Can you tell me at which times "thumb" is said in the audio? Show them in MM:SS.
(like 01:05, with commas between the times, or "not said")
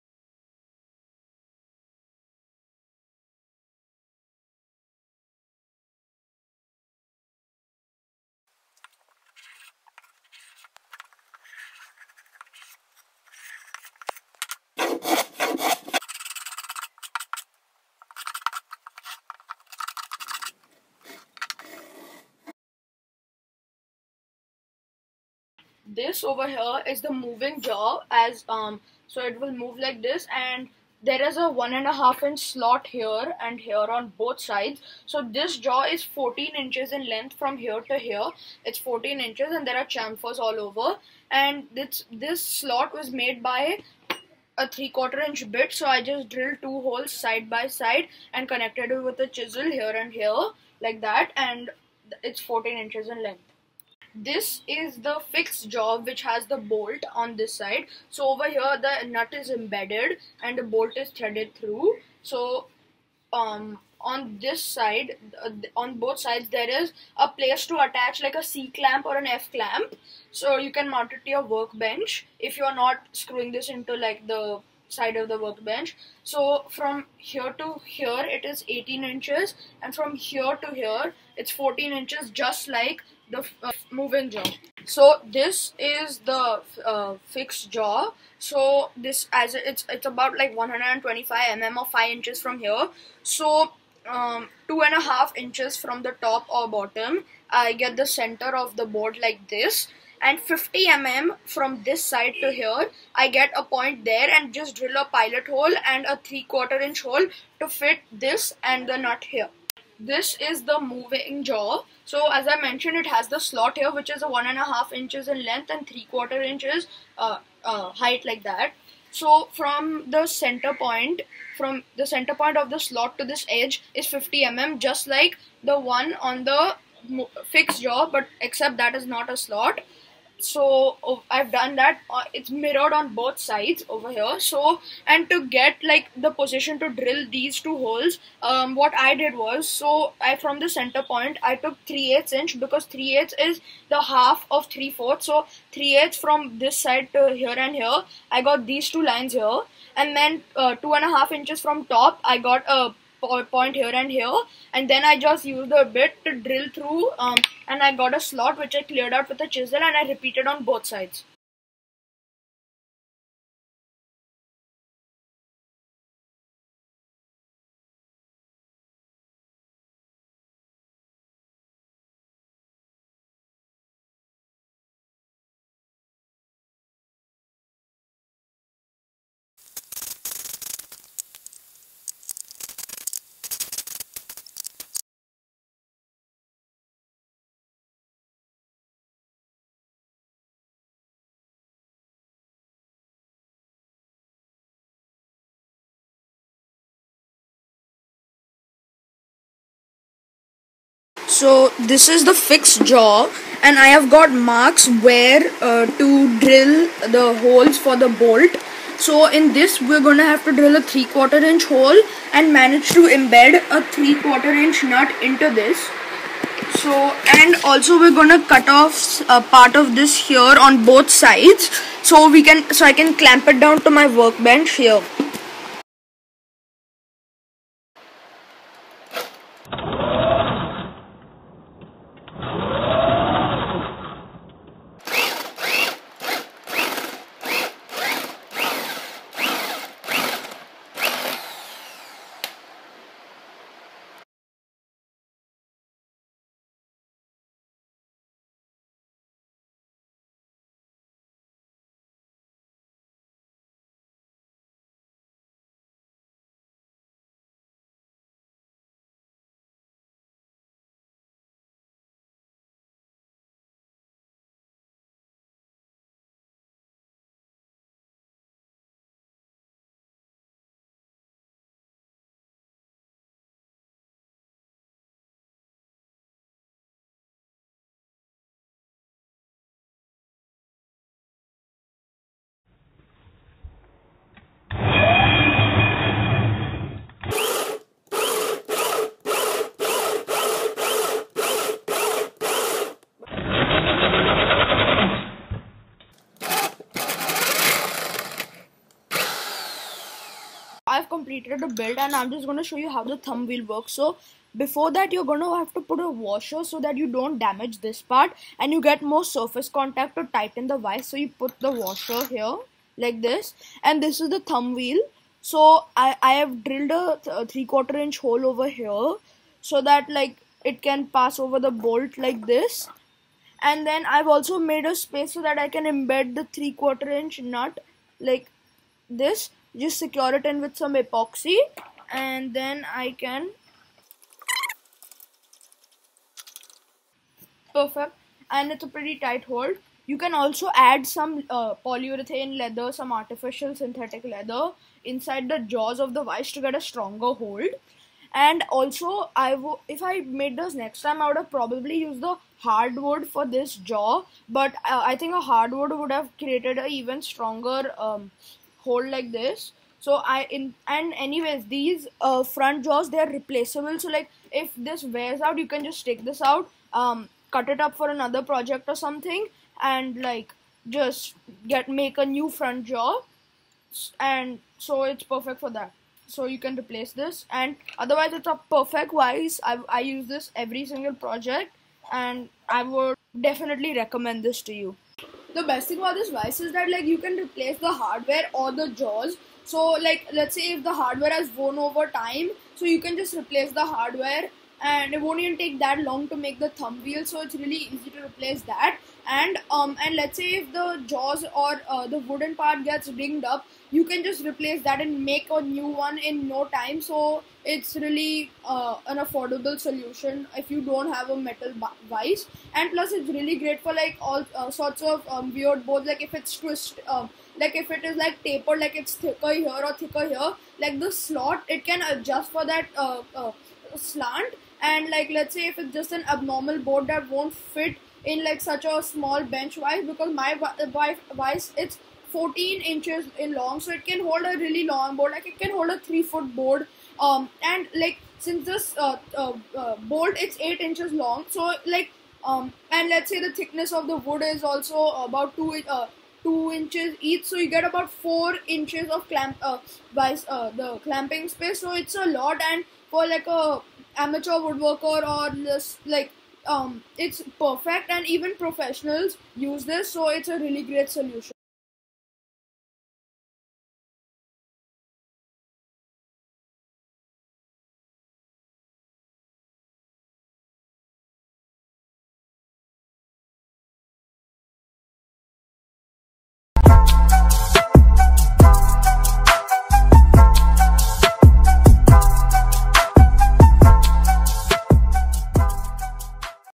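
05:03, 05:14, 06:36.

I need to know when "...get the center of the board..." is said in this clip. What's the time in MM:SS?
01:37.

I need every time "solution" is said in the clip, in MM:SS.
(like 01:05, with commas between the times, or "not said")
06:49, 07:41.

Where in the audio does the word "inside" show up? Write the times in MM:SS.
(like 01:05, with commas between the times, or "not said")
05:45.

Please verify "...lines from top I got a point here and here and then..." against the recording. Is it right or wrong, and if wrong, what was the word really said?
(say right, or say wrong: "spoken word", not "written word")
wrong: "inches", not "lines".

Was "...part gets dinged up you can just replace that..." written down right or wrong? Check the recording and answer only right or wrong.
right.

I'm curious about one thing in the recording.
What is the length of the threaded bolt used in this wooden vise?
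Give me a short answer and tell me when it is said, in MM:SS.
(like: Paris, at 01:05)
8 inches, at 07:20.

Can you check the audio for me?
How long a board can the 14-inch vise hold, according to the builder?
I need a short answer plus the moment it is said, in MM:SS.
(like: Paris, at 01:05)
3 foot, at 07:16.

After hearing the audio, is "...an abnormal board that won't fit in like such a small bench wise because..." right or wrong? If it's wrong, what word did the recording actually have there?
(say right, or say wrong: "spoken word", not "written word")
right.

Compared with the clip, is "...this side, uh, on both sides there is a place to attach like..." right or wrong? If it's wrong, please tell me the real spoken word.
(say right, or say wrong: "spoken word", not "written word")
right.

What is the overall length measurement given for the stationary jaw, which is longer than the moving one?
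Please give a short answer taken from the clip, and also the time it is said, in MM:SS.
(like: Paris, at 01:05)
18 inches, at 01:18.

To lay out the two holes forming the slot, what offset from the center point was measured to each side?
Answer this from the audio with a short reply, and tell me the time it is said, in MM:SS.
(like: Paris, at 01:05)
3/8 inch, at 02:21.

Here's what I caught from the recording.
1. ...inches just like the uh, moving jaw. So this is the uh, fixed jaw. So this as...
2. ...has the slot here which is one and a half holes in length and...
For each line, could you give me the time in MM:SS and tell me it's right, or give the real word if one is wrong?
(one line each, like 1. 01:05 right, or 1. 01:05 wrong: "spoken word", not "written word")
1. 01:21 right
2. 01:53 wrong: "inches", not "holes".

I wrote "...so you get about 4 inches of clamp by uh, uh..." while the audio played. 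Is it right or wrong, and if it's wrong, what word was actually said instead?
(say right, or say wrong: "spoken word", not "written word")
right.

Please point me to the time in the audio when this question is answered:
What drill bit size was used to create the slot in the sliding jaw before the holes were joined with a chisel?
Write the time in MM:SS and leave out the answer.
00:44.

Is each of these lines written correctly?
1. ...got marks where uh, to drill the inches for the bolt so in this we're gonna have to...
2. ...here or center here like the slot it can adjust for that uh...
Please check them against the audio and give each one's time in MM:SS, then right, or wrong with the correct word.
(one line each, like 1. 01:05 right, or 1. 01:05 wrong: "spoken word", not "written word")
1. 03:24 wrong: "holes", not "inches"
2. 06:59 wrong: "thicker", not "center".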